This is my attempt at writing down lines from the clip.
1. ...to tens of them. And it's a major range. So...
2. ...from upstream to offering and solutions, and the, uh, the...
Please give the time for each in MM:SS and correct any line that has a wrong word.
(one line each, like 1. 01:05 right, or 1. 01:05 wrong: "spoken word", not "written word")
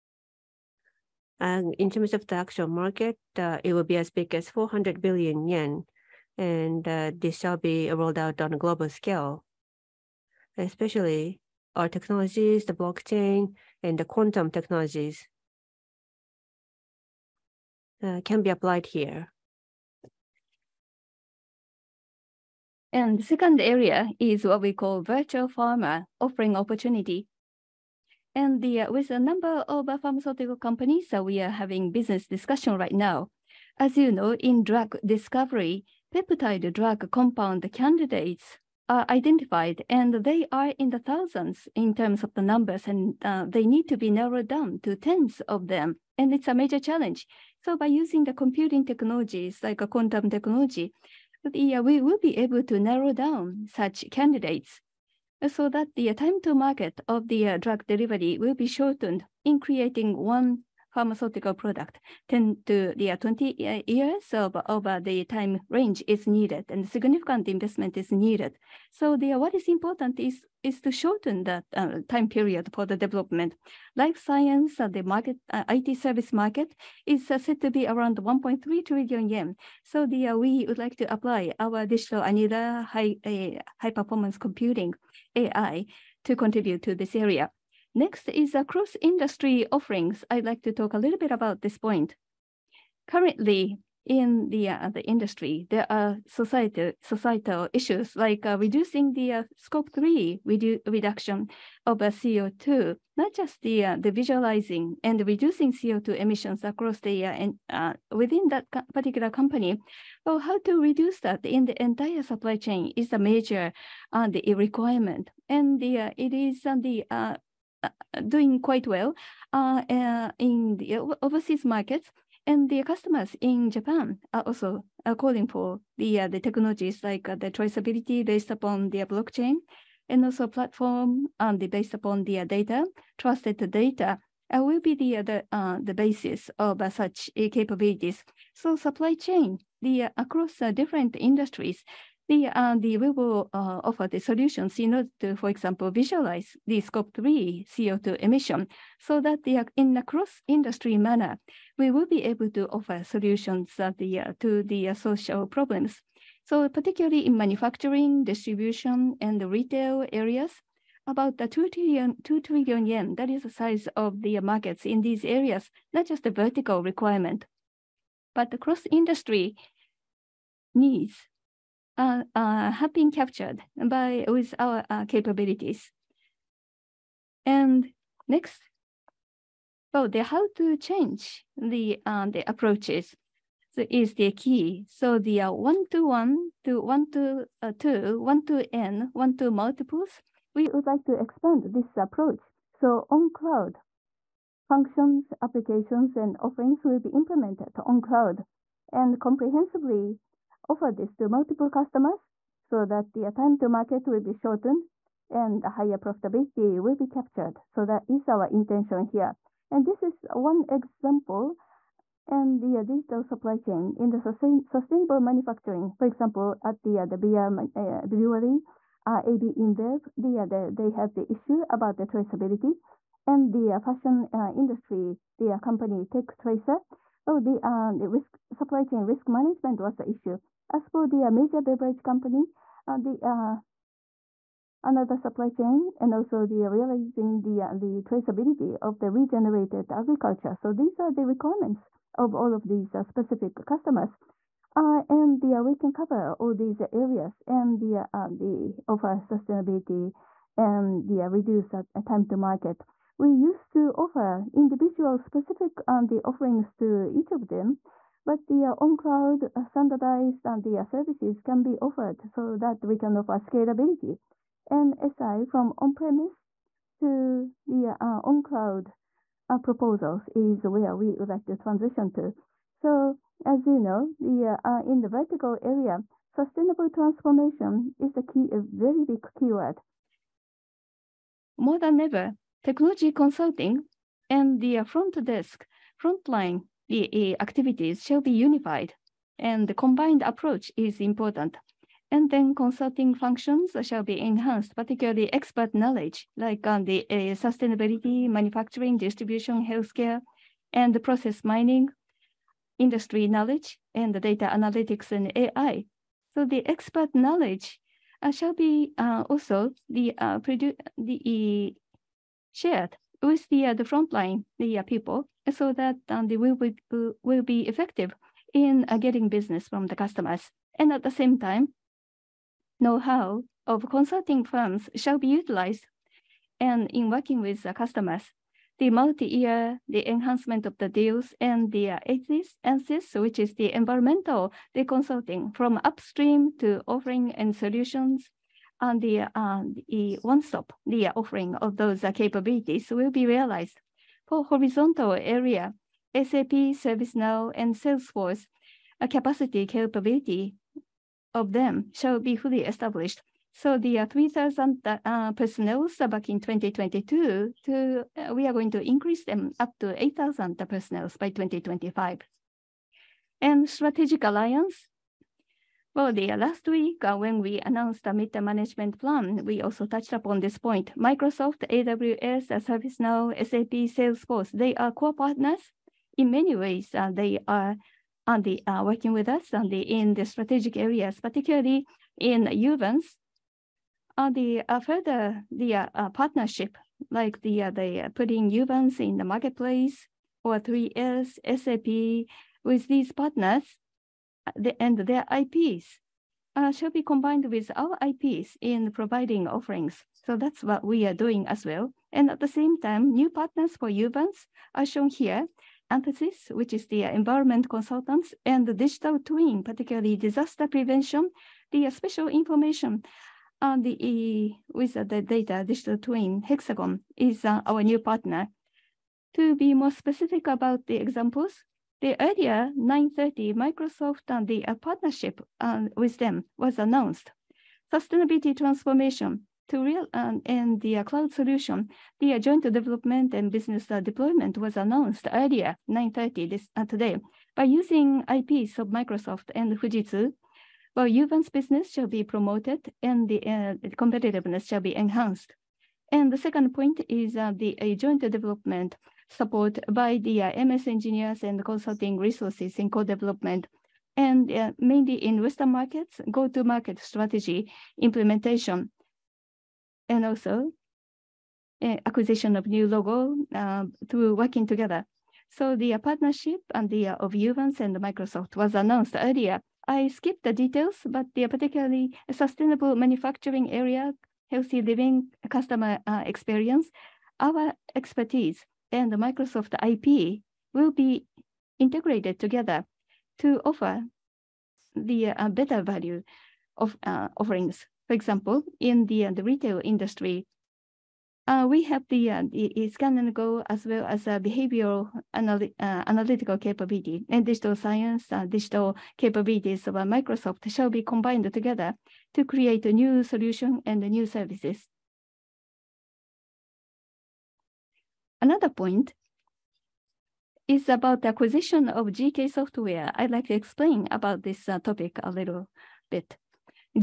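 1. 00:44 wrong: "challenge", not "range"
2. 05:35 right.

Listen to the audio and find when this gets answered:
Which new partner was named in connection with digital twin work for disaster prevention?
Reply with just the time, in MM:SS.
06:56.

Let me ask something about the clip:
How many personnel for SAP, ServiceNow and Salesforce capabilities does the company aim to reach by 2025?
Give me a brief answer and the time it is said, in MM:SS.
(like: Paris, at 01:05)
8,000, at 06:00.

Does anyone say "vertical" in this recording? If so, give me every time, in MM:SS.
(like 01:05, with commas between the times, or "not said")
02:46, 04:35.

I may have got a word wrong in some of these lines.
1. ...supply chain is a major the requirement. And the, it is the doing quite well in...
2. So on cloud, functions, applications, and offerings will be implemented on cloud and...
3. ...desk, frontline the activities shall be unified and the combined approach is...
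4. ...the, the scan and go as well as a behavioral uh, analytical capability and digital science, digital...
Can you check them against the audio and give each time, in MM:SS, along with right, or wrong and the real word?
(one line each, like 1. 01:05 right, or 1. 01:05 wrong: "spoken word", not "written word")
1. 01:52 right
2. 03:12 right
3. 04:45 right
4. 08:12 right.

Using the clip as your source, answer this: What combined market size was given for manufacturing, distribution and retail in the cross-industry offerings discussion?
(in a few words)
2 trillion yen.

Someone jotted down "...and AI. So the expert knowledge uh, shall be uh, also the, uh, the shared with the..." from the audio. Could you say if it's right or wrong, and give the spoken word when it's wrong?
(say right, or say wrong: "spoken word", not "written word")
right.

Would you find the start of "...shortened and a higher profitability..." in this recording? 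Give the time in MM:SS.
03:24.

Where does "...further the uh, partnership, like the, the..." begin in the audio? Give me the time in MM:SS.
06:24.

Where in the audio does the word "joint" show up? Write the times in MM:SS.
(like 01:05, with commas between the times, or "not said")
07:12, 07:27.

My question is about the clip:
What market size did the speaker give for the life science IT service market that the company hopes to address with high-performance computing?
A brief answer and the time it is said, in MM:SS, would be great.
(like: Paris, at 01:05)
1.3 trillion yen, at 01:18.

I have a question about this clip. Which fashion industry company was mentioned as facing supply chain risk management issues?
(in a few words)
Tech Tracer.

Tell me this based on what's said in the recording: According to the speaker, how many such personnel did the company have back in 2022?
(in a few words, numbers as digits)
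3,000.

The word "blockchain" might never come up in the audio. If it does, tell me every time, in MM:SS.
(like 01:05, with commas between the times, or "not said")
00:12, 02:09.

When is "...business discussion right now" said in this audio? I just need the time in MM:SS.
00:31.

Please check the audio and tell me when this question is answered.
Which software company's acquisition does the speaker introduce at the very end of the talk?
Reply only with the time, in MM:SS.
08:32.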